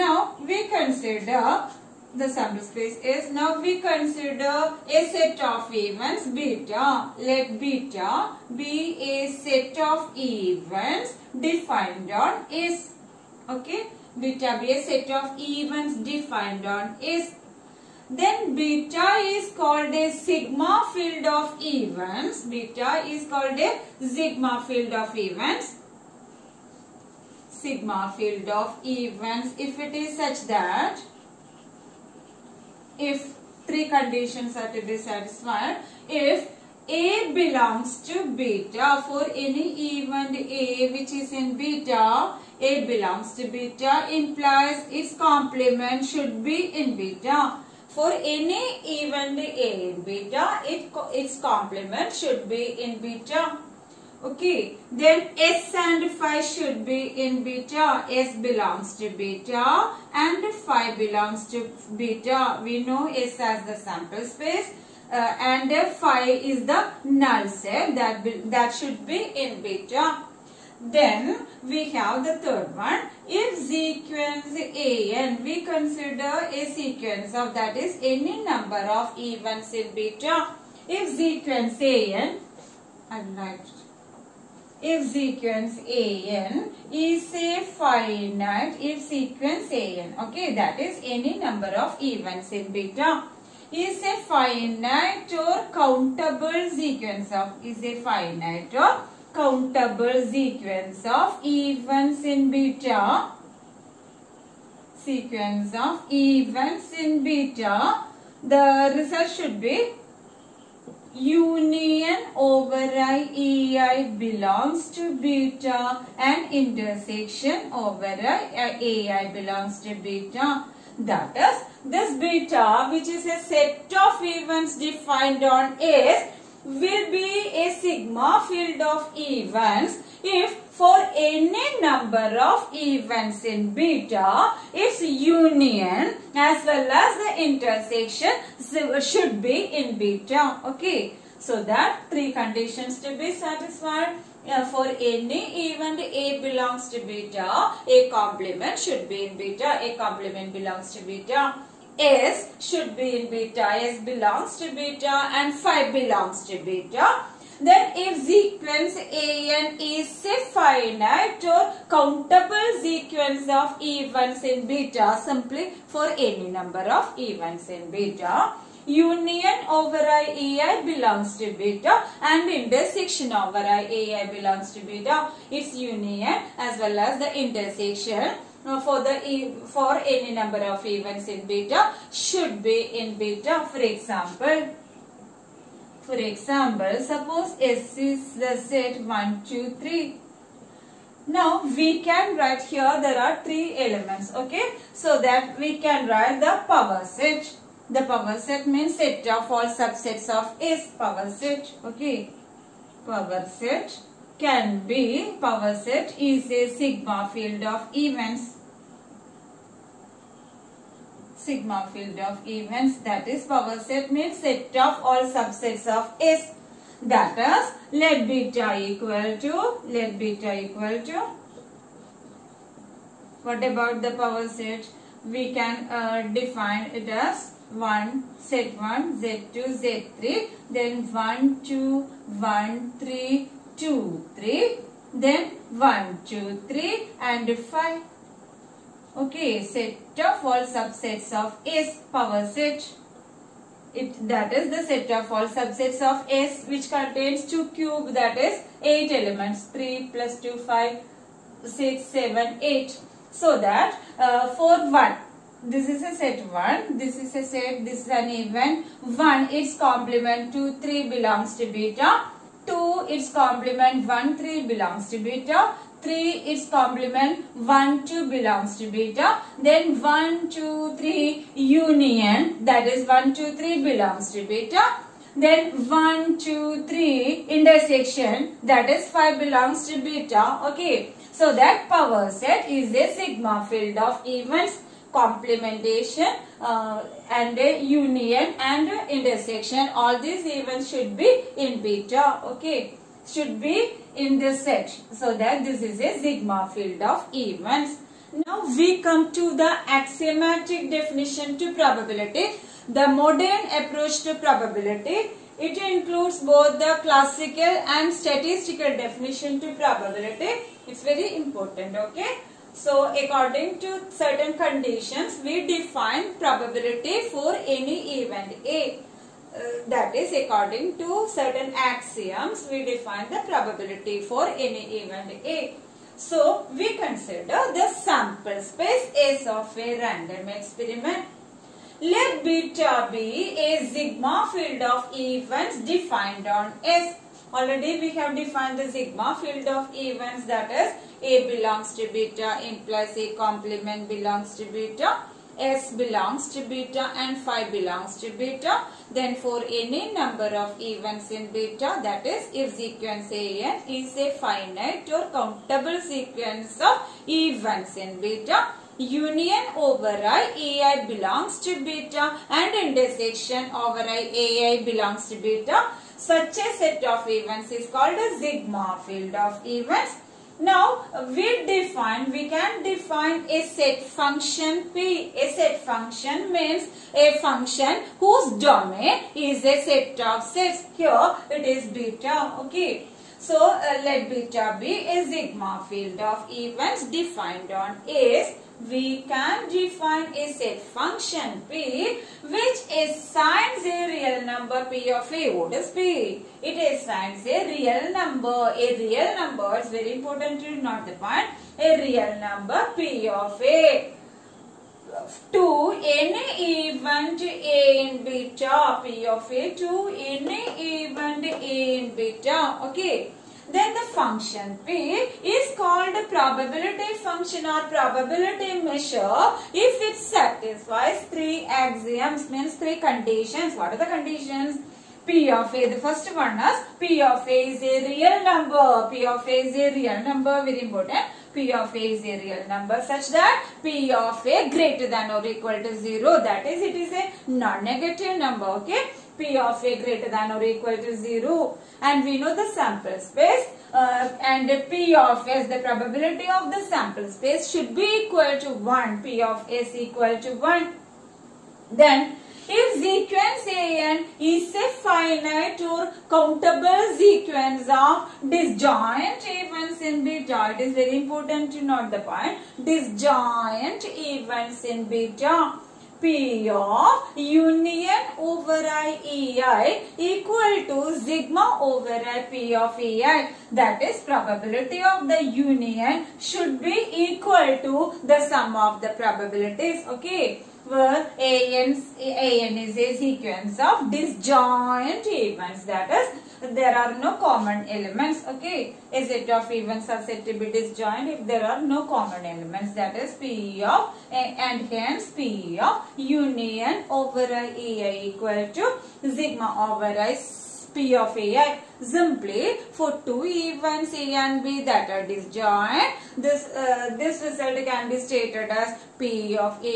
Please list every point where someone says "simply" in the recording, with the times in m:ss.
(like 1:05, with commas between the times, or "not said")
2:45, 8:22.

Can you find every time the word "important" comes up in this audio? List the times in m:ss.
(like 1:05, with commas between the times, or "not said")
5:11, 6:40, 7:10, 7:41.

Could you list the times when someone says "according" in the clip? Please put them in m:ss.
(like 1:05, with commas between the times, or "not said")
5:13, 5:20.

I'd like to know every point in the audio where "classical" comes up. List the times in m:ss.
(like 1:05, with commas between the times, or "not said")
5:07.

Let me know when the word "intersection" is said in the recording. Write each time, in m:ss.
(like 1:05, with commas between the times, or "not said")
1:56, 2:17, 2:52, 2:57, 4:37, 4:49, 6:02.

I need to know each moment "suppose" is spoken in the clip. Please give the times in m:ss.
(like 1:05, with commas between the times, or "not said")
3:07.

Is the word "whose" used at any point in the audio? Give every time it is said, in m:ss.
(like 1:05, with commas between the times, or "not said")
6:18.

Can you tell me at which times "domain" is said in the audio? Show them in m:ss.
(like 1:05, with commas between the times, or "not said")
6:18.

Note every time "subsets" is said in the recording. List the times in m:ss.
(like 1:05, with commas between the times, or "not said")
3:19, 3:35, 4:00, 4:05.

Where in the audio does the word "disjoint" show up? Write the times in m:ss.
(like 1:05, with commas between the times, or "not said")
7:38, 7:42, 8:04, 8:10, 8:25.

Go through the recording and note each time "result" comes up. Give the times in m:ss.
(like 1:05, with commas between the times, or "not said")
1:48, 8:27.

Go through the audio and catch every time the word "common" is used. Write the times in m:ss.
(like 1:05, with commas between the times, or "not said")
8:07, 8:12.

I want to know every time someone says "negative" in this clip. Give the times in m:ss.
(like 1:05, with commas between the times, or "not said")
7:17.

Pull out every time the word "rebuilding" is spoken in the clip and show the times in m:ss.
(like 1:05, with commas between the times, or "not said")
not said.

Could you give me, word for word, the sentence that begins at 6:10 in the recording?
Now, we define, we can define a set function P.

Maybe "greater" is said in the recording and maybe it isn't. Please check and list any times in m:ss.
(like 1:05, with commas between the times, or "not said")
7:14, 7:20.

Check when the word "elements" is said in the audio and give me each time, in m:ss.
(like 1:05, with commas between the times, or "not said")
3:13, 4:09, 8:07, 8:12.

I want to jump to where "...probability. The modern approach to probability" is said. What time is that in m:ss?
5:01.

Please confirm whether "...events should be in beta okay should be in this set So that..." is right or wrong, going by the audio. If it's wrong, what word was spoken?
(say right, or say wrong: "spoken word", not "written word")
right.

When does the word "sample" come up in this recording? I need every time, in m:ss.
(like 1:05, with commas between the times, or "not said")
0:02, 1:03, 5:27, 7:22, 7:26.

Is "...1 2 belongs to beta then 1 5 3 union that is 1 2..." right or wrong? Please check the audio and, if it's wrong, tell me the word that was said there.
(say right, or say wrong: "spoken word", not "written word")
wrong: "2", not "5".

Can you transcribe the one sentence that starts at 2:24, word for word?
Yeah, uh, for any event A belongs to beta, A complement should be in beta, A complement belongs to beta.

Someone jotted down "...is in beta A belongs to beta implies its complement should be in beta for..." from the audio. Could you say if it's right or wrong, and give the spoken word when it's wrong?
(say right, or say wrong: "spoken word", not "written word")
right.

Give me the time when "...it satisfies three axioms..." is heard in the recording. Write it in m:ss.
7:00.